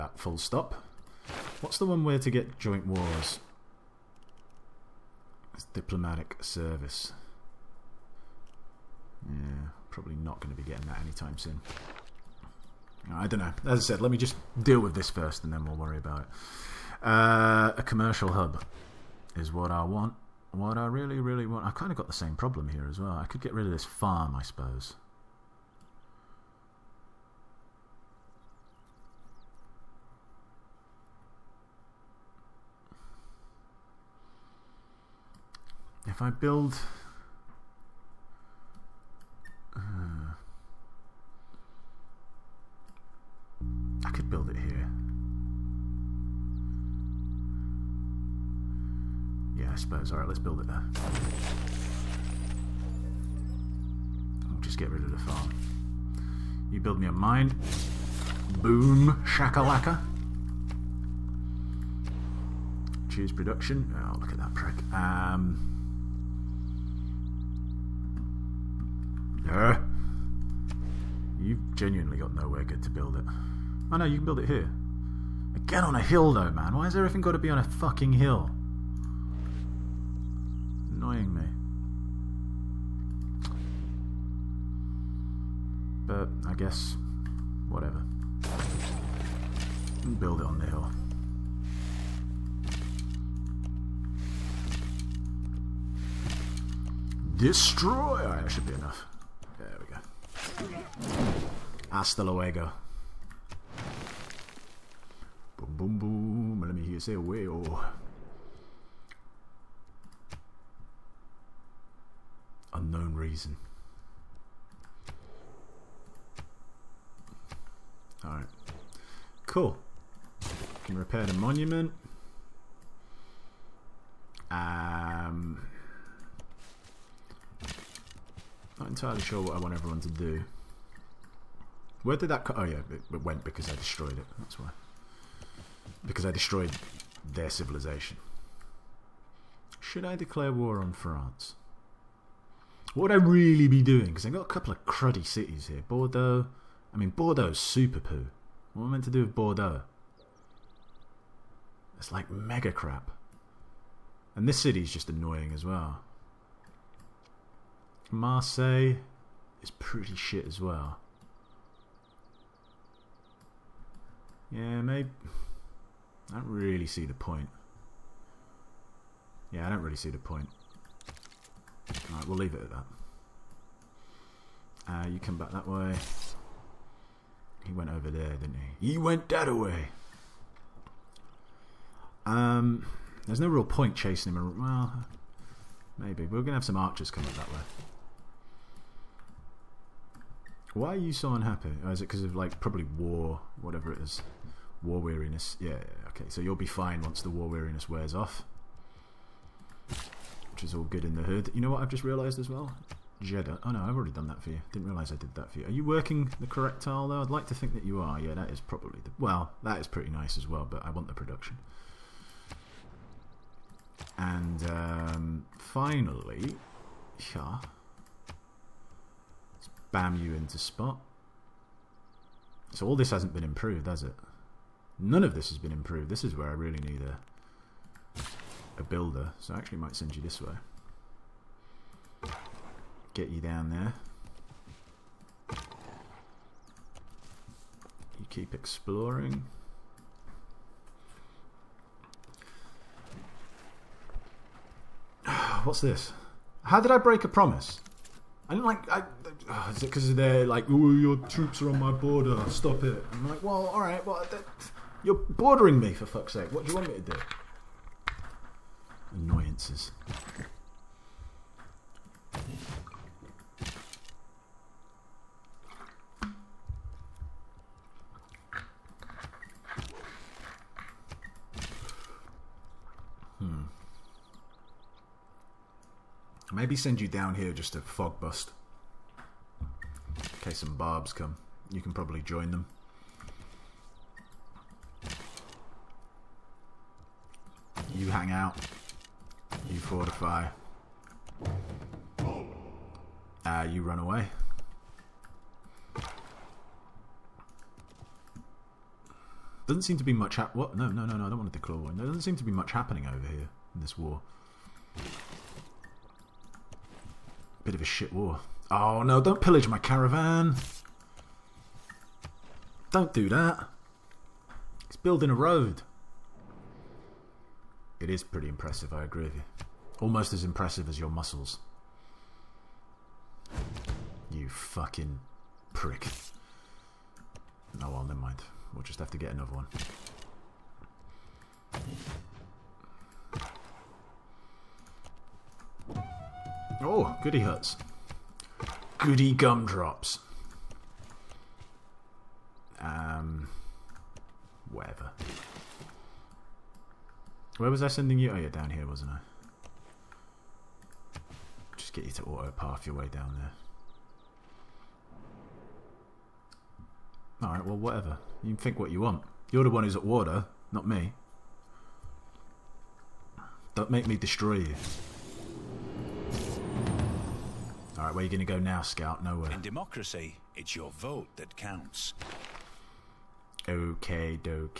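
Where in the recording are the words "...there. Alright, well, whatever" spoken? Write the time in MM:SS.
05:57.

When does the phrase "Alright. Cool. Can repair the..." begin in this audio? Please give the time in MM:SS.
01:58.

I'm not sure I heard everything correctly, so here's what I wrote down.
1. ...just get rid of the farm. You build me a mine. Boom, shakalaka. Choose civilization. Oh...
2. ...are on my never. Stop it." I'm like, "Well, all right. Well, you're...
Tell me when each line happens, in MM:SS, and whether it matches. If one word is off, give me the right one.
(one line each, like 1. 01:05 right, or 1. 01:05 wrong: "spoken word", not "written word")
1. 00:54 wrong: "production", not "civilization"
2. 04:11 wrong: "border", not "never".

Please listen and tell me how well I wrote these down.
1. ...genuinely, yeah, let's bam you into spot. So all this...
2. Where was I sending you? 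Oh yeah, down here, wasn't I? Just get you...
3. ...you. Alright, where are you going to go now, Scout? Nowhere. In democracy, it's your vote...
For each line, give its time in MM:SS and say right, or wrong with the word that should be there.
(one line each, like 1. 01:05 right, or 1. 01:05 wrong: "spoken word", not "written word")
1. 03:35 wrong: "finally", not "genuinely"
2. 05:47 right
3. 06:04 right.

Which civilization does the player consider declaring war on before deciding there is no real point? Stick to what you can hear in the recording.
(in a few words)
France.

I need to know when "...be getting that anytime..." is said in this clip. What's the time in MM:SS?
00:10.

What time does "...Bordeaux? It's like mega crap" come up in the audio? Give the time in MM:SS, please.
02:29.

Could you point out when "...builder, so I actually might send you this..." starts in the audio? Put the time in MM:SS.
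03:48.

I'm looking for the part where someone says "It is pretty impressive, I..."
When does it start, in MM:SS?
05:18.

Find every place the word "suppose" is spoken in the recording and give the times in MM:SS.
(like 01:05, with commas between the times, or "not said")
00:24, 00:49.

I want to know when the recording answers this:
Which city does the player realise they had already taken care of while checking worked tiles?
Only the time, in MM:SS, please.
03:23.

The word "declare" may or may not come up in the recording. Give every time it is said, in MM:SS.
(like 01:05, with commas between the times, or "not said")
02:20, 05:01.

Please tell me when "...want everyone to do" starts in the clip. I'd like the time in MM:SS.
02:09.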